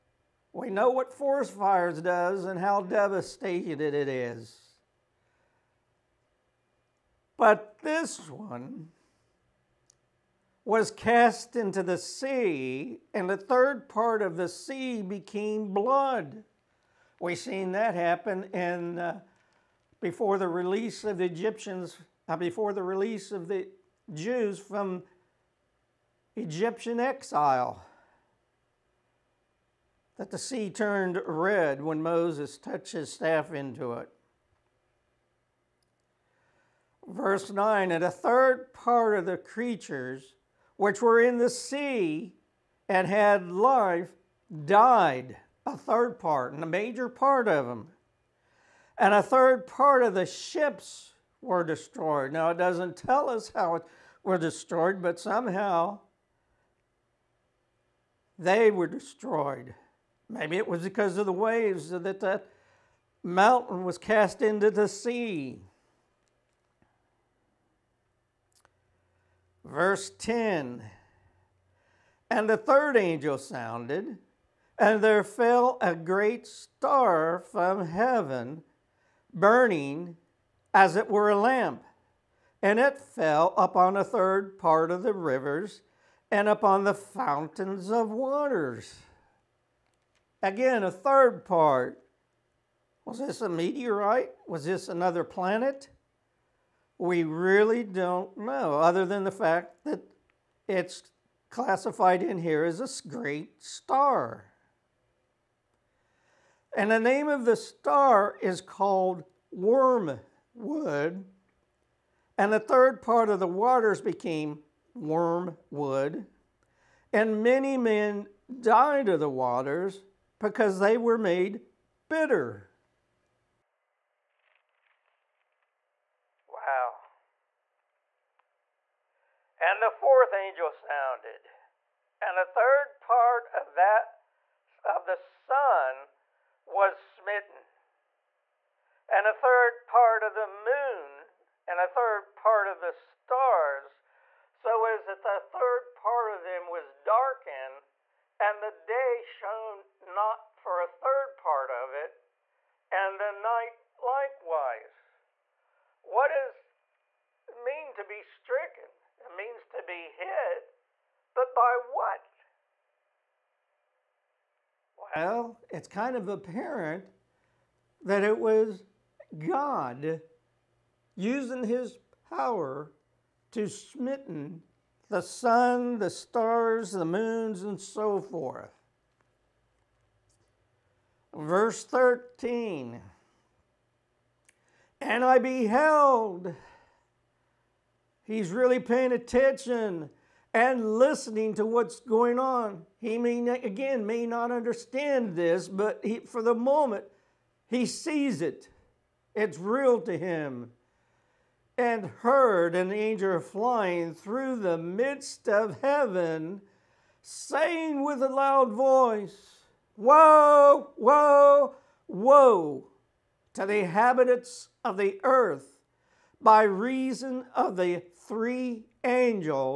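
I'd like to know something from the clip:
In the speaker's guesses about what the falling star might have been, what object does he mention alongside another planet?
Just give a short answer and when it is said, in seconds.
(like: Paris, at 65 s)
A meteorite, at 93 s.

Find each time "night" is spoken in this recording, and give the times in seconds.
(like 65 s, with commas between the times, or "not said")
153 s.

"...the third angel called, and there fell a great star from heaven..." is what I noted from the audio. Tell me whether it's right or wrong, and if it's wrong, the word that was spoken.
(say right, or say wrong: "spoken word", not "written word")
wrong: "sounded", not "called".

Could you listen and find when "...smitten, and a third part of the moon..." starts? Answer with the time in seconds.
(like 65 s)
137 s.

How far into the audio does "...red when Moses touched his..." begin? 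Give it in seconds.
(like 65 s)
31 s.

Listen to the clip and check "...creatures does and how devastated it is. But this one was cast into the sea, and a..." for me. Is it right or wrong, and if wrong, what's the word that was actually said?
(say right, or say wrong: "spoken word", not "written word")
wrong: "fires", not "creatures".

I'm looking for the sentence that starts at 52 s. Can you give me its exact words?
Now, it doesn't tell us how it were destroyed, but somehow they were destroyed.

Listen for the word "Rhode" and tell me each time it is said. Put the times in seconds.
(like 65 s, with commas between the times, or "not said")
not said.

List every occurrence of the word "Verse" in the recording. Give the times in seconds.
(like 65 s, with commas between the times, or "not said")
37 s, 69 s, 181 s.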